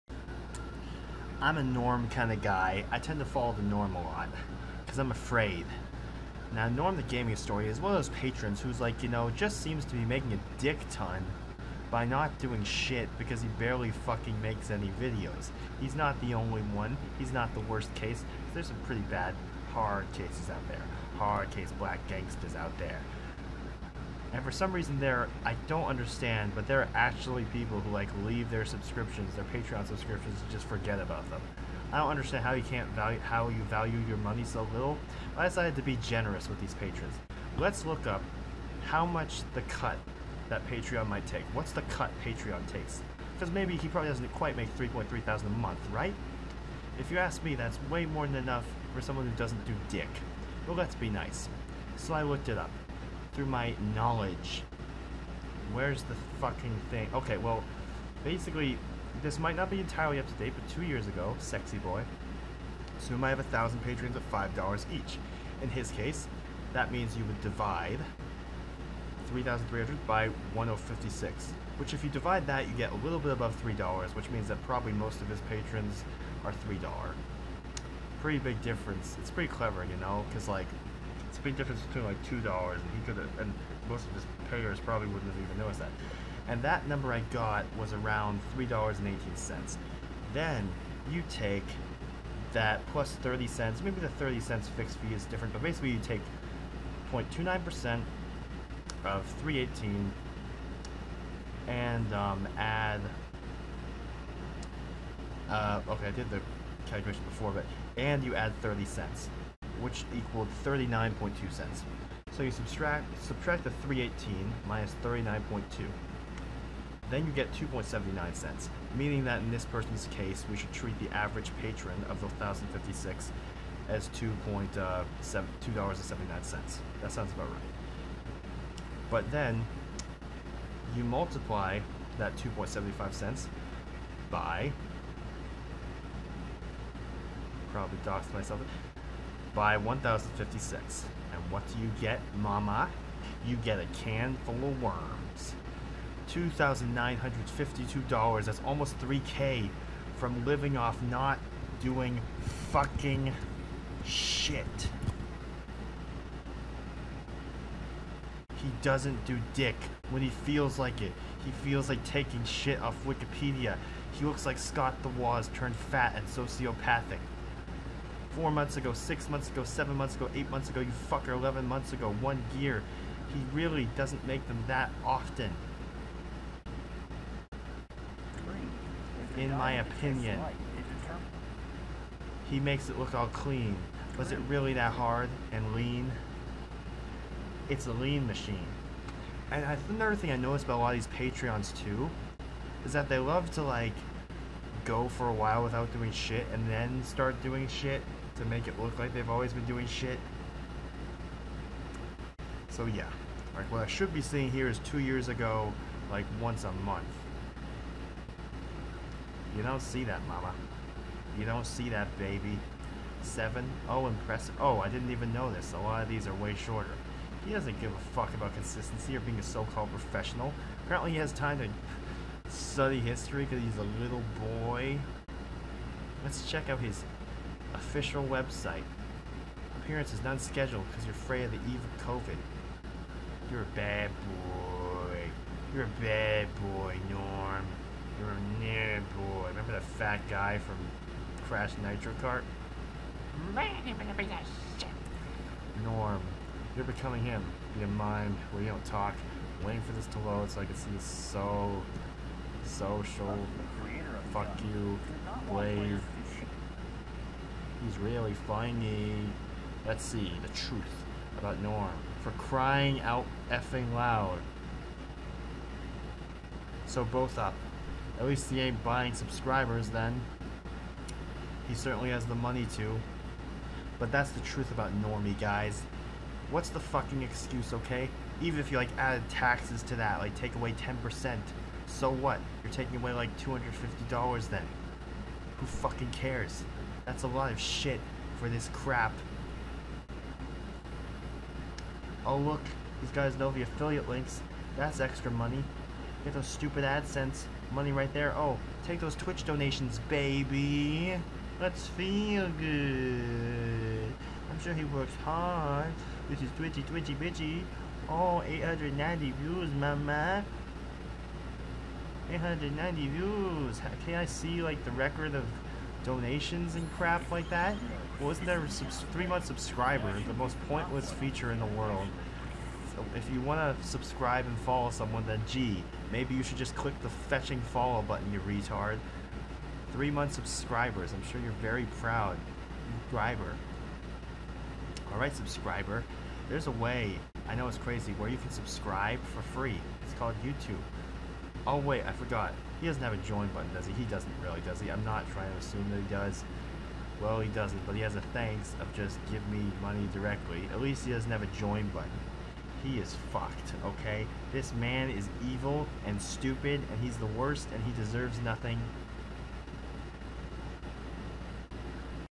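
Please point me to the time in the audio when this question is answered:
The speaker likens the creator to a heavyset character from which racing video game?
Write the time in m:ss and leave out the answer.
4:01.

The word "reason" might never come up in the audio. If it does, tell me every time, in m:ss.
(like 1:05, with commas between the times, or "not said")
0:24.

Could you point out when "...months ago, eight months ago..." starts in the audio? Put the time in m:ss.
2:49.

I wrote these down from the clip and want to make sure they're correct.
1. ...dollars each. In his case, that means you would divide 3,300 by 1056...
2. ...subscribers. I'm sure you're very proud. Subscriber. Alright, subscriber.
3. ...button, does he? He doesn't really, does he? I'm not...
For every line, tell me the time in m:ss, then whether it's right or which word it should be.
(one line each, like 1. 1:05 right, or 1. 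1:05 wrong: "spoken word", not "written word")
1. 1:04 right
2. 5:30 right
3. 5:43 right.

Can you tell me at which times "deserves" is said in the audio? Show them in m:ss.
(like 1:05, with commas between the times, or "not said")
5:58.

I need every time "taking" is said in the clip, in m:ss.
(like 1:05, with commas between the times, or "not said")
2:42, 4:42.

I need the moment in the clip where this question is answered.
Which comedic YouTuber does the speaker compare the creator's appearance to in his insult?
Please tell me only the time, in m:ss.
2:44.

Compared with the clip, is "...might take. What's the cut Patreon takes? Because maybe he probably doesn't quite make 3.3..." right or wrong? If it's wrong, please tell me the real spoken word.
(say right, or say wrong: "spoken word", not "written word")
right.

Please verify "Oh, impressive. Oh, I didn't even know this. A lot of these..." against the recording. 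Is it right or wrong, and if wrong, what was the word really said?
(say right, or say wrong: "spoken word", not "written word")
right.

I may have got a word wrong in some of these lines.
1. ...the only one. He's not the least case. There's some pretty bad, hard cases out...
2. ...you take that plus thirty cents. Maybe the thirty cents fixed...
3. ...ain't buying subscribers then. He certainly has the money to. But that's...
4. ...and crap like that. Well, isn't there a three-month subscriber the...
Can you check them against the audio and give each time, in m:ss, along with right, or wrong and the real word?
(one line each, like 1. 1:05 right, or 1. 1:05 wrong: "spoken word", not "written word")
1. 0:16 wrong: "worst", not "least"
2. 1:31 right
3. 4:28 right
4. 5:16 right.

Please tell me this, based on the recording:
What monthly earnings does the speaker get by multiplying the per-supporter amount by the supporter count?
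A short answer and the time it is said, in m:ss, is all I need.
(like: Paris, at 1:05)
$2,952, at 2:26.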